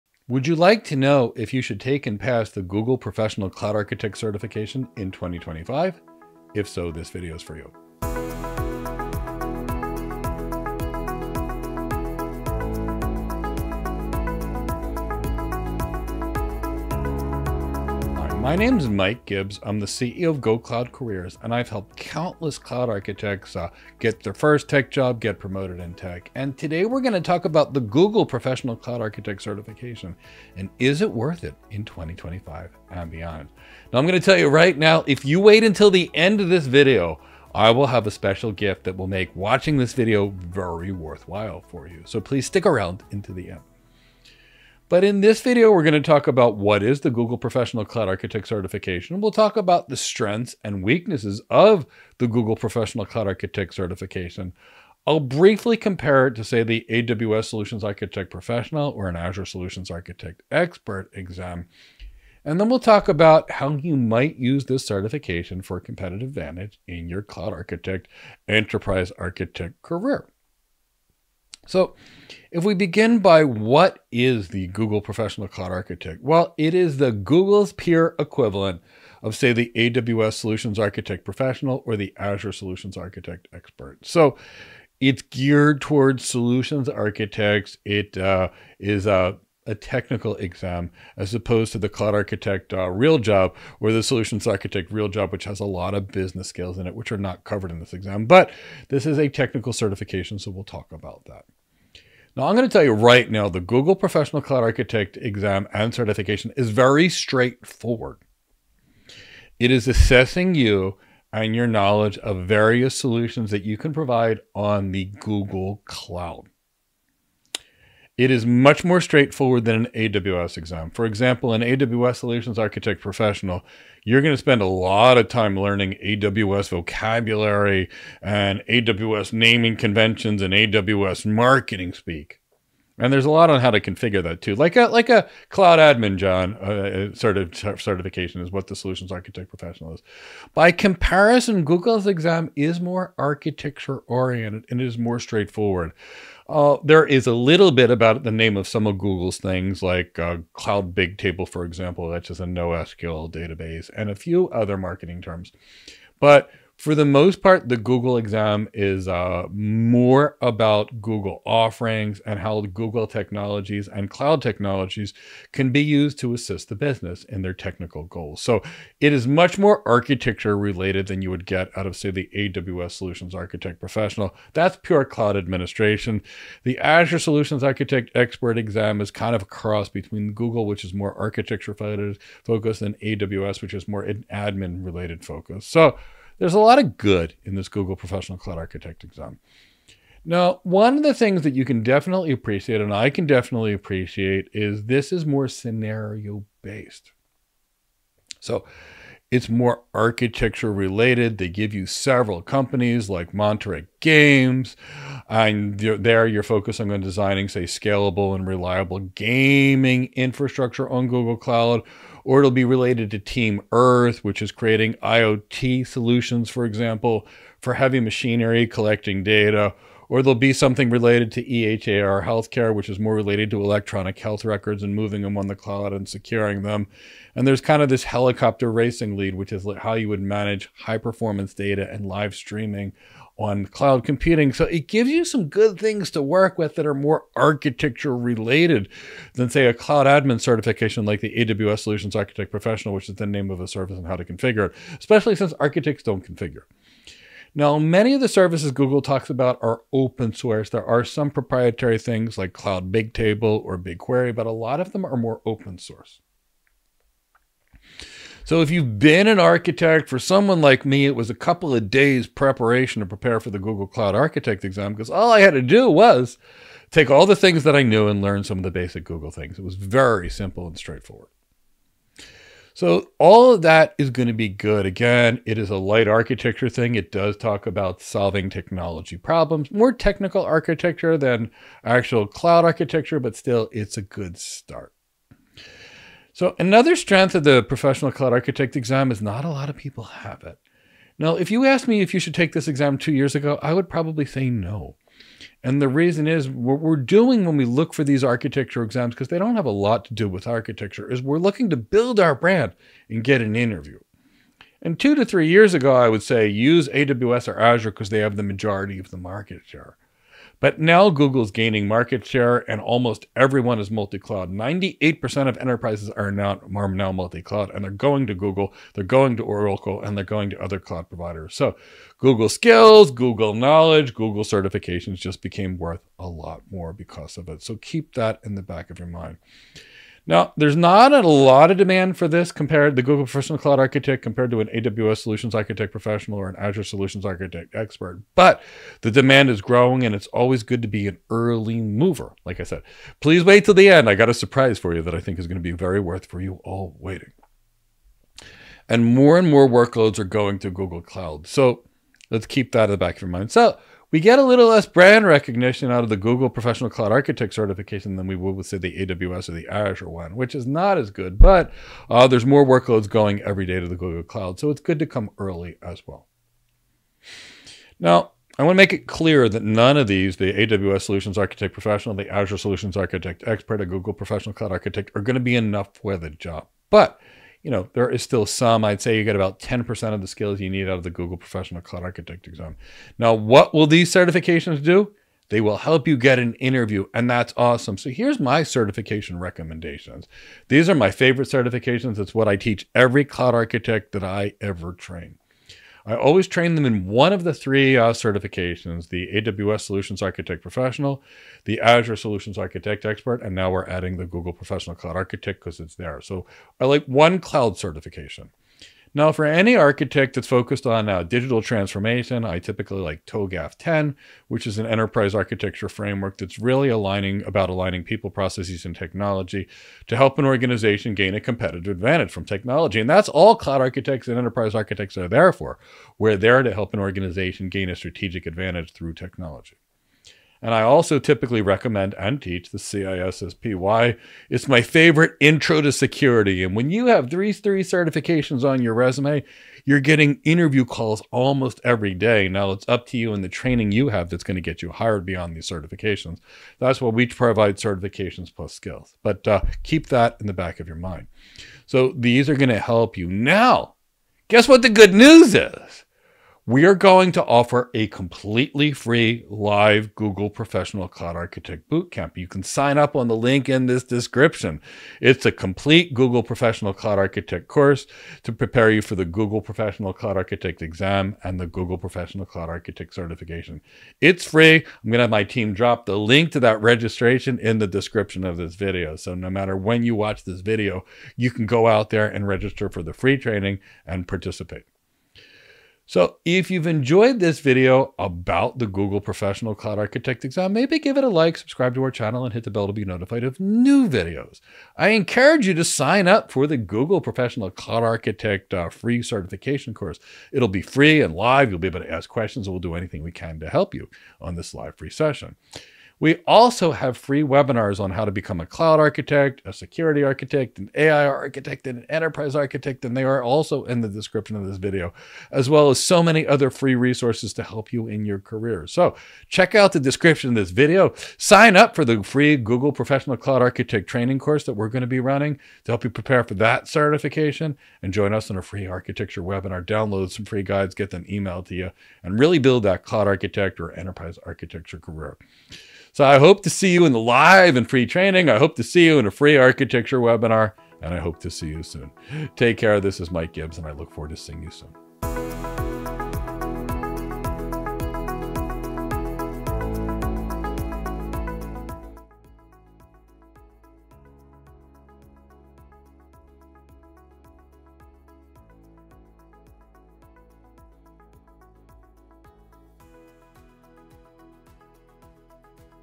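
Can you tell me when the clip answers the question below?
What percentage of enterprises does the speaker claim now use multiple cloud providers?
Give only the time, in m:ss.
5:14.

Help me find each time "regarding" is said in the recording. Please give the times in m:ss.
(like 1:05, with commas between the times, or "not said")
not said.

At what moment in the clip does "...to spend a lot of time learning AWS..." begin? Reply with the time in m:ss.
2:04.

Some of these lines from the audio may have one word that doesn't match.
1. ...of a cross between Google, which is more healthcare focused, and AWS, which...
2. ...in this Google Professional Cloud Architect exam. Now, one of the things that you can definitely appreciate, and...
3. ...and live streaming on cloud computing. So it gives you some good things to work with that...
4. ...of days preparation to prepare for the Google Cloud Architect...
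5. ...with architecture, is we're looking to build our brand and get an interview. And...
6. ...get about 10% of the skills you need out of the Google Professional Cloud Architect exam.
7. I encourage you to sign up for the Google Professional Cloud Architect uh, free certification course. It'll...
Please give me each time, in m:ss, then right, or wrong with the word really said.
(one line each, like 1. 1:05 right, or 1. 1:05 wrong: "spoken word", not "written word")
1. 2:59 wrong: "architecture", not "healthcare"
2. 3:07 right
3. 3:51 right
4. 4:21 right
5. 5:00 right
6. 6:19 right
7. 8:14 right.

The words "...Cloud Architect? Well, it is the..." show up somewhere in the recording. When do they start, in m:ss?
1:15.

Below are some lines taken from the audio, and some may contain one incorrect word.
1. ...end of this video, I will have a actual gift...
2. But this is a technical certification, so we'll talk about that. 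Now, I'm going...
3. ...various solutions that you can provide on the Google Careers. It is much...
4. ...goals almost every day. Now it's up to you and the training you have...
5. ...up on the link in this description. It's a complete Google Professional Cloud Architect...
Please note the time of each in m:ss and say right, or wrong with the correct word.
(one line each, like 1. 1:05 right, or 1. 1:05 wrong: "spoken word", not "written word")
1. 0:36 wrong: "special", not "actual"
2. 1:38 right
3. 1:52 wrong: "Cloud", not "Careers"
4. 7:20 wrong: "calls", not "goals"
5. 7:42 right.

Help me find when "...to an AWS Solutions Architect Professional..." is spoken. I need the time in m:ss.
5:34.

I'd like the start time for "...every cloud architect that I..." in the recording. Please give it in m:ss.
6:32.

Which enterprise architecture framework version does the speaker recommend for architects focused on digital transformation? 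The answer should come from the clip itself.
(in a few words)
TOGAF 10.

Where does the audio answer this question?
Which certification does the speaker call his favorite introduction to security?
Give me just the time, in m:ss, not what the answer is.
7:12.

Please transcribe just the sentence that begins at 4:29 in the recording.
It was very simple and straightforward.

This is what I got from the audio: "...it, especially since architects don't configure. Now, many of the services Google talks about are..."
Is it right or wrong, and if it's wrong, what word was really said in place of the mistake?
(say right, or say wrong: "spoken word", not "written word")
right.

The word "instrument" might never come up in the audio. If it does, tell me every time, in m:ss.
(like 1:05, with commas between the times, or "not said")
not said.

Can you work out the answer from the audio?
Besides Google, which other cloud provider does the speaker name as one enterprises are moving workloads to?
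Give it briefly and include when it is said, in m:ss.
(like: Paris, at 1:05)
Oracle, at 5:19.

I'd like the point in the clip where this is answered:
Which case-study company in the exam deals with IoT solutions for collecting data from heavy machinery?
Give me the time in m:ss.
3:33.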